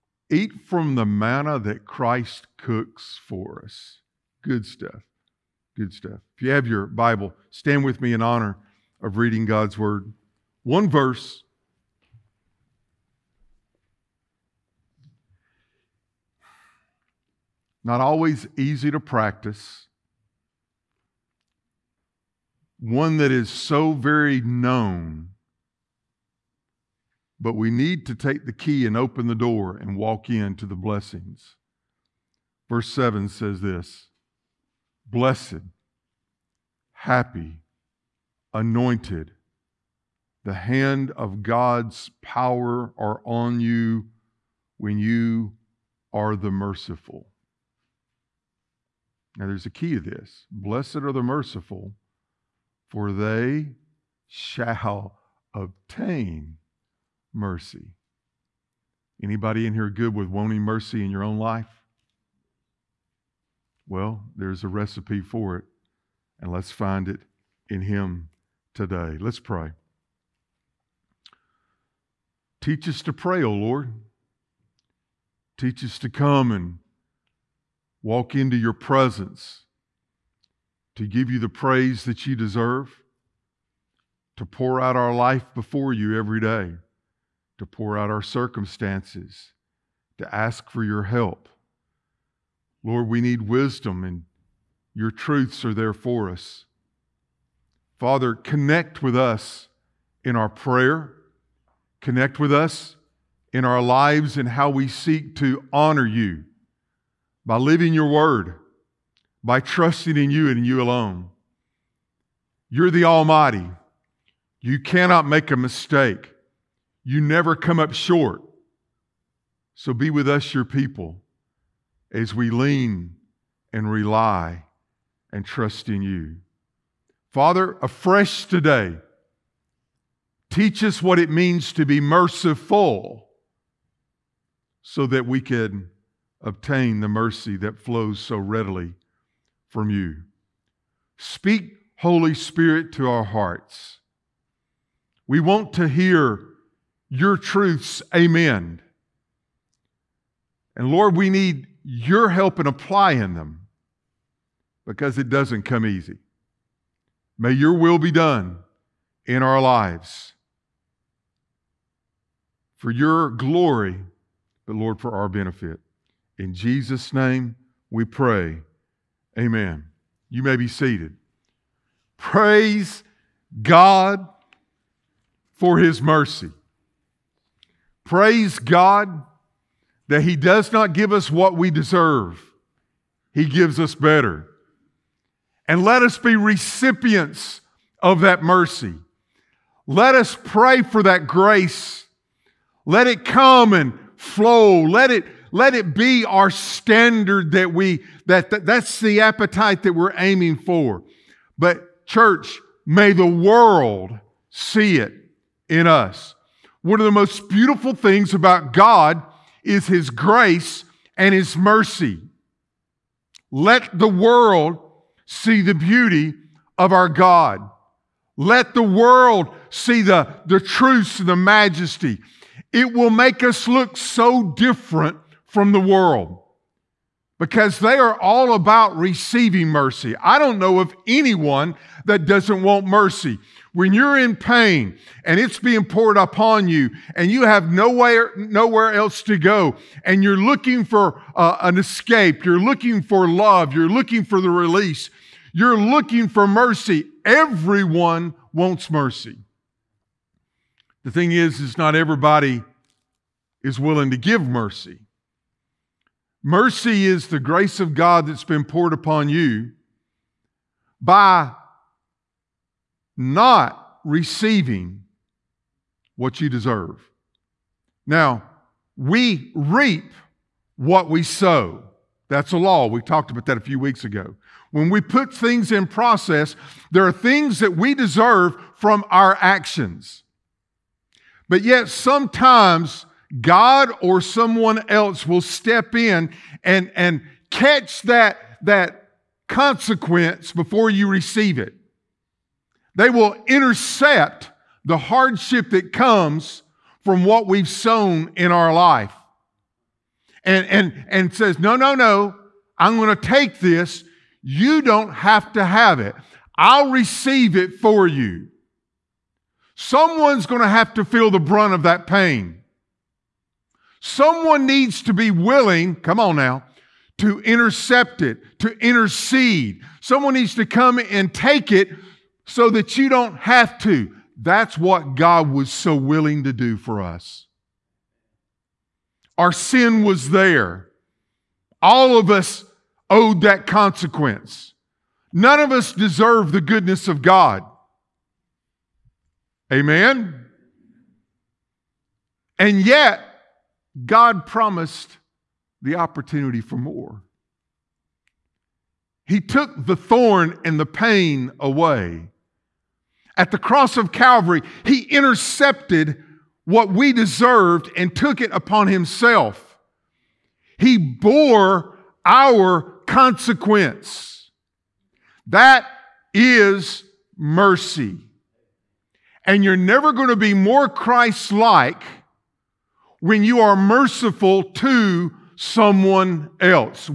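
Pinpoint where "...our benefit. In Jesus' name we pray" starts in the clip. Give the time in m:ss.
2:45.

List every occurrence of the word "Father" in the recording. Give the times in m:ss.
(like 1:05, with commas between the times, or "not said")
1:37, 2:07.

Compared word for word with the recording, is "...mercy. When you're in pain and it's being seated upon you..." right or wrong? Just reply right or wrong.
wrong.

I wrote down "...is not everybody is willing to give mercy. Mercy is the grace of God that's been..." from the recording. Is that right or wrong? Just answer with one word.
right.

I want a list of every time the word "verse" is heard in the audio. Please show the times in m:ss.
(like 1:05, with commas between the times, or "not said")
0:10, 0:32.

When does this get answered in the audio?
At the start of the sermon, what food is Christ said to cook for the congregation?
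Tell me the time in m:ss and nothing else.
0:01.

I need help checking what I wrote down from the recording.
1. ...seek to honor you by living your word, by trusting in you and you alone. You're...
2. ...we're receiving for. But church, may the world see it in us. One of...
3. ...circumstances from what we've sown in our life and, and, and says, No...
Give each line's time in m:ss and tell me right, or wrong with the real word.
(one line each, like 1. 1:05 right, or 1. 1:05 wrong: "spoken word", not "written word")
1. 1:44 right
2. 3:19 wrong: "aiming", not "receiving"
3. 4:55 wrong: "comes", not "circumstances".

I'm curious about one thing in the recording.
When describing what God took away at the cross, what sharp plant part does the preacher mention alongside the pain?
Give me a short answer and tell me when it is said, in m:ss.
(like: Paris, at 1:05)
The thorn, at 5:49.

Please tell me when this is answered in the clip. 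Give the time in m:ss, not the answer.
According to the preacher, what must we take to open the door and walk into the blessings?
0:28.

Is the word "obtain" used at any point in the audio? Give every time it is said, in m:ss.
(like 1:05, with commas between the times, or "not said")
0:55, 2:16.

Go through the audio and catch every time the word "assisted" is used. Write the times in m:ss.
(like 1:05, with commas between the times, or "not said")
not said.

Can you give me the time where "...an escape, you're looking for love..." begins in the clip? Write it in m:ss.
4:01.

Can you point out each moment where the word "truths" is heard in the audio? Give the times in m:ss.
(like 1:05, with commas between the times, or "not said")
1:35, 2:27, 3:40.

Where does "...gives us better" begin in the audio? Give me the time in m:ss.
3:03.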